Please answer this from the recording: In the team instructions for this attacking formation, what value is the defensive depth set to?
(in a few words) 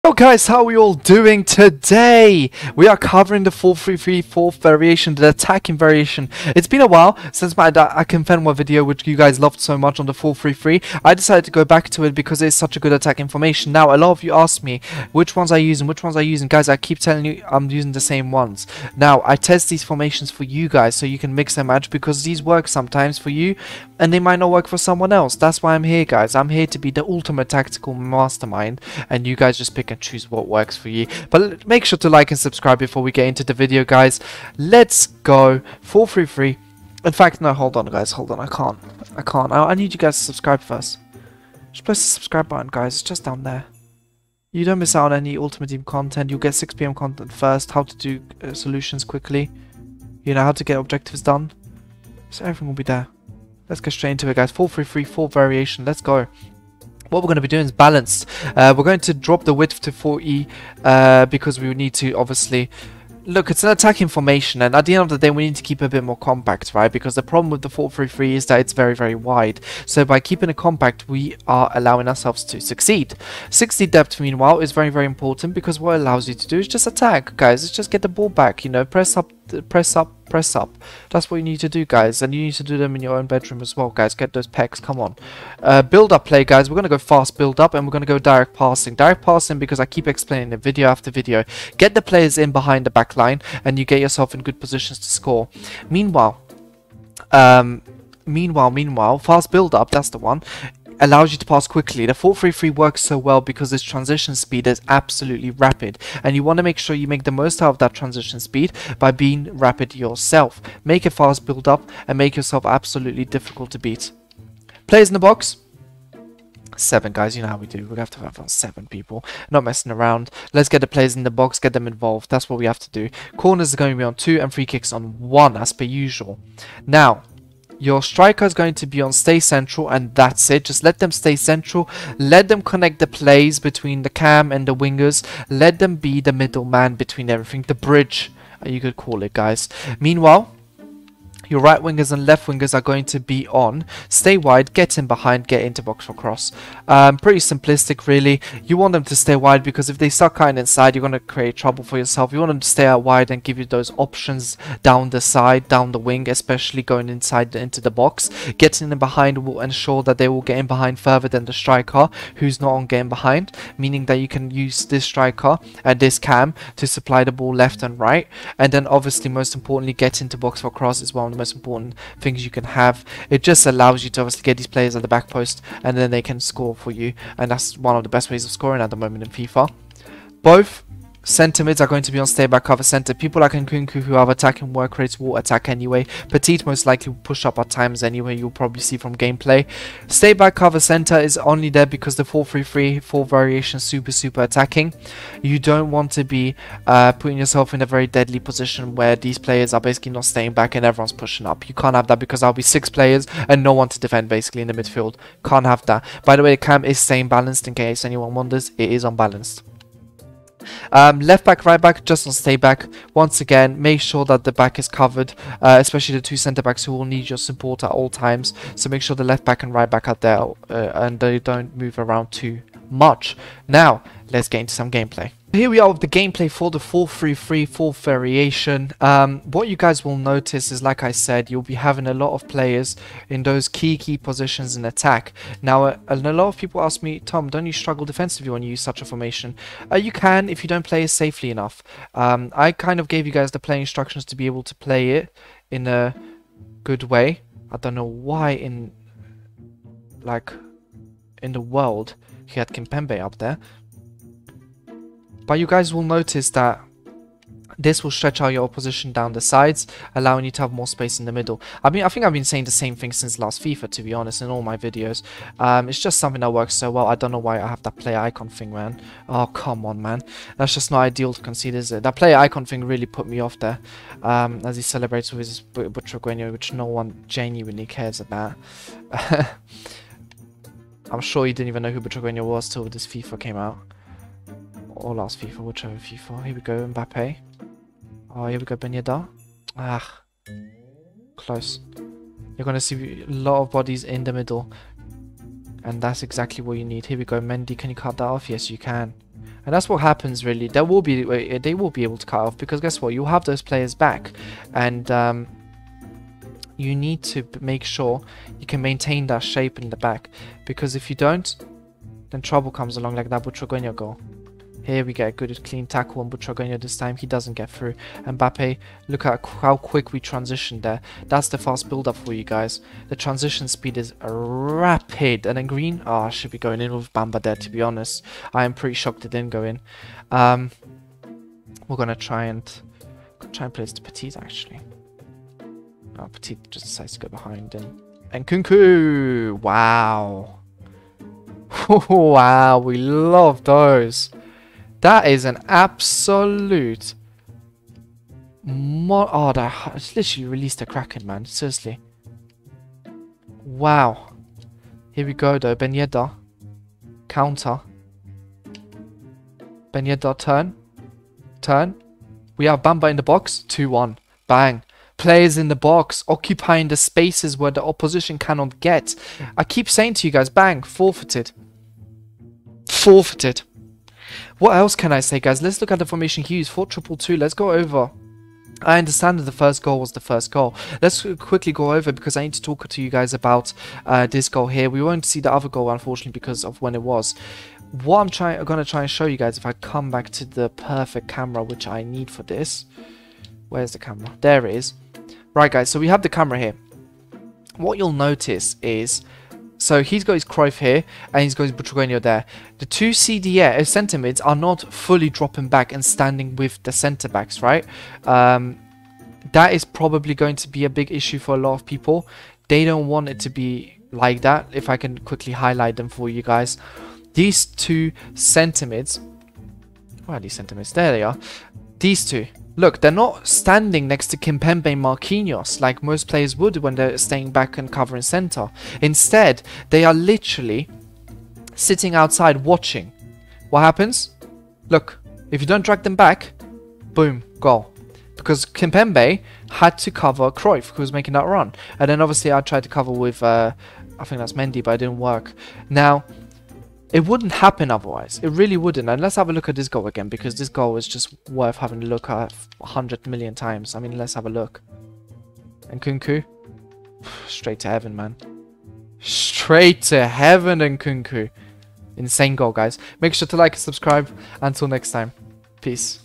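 60.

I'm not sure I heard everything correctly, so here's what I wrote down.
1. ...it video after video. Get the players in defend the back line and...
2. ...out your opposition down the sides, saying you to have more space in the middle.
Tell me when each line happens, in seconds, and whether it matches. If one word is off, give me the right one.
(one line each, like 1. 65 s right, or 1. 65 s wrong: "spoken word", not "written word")
1. 90 s wrong: "behind", not "defend"
2. 258 s wrong: "allowing", not "saying".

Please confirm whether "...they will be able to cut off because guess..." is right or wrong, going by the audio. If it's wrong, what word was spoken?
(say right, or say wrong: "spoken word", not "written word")
right.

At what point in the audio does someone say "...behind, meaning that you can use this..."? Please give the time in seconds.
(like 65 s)
163 s.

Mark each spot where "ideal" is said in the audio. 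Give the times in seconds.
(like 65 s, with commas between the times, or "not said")
271 s.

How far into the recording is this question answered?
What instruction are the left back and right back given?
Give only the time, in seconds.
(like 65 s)
212 s.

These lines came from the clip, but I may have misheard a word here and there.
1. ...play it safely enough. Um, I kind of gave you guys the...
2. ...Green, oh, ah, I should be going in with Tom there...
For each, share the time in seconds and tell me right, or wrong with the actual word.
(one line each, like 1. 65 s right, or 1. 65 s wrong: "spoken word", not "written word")
1. 240 s right
2. 325 s wrong: "Bamba", not "Tom".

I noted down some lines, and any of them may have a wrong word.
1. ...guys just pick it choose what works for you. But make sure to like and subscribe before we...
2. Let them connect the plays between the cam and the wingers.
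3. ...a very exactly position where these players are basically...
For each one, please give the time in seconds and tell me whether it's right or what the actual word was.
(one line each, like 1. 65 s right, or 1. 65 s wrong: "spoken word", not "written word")
1. 29 s right
2. 132 s right
3. 197 s wrong: "deadly", not "exactly".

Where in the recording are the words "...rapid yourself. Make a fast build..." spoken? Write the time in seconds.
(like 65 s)
109 s.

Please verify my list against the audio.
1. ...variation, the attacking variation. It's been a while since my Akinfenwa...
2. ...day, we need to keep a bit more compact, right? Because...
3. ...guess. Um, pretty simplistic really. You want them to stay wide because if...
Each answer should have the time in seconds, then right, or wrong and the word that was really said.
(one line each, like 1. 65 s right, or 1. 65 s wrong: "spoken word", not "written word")
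1. 4 s right
2. 65 s right
3. 146 s wrong: "cross", not "guess".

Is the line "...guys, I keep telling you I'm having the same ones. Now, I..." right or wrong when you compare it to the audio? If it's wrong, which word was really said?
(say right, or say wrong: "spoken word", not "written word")
wrong: "using", not "having".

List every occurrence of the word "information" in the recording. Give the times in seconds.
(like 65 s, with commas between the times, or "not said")
13 s.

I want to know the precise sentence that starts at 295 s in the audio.
And that's exactly what you need.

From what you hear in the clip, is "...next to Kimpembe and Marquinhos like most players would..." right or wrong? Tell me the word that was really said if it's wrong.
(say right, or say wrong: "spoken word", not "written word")
right.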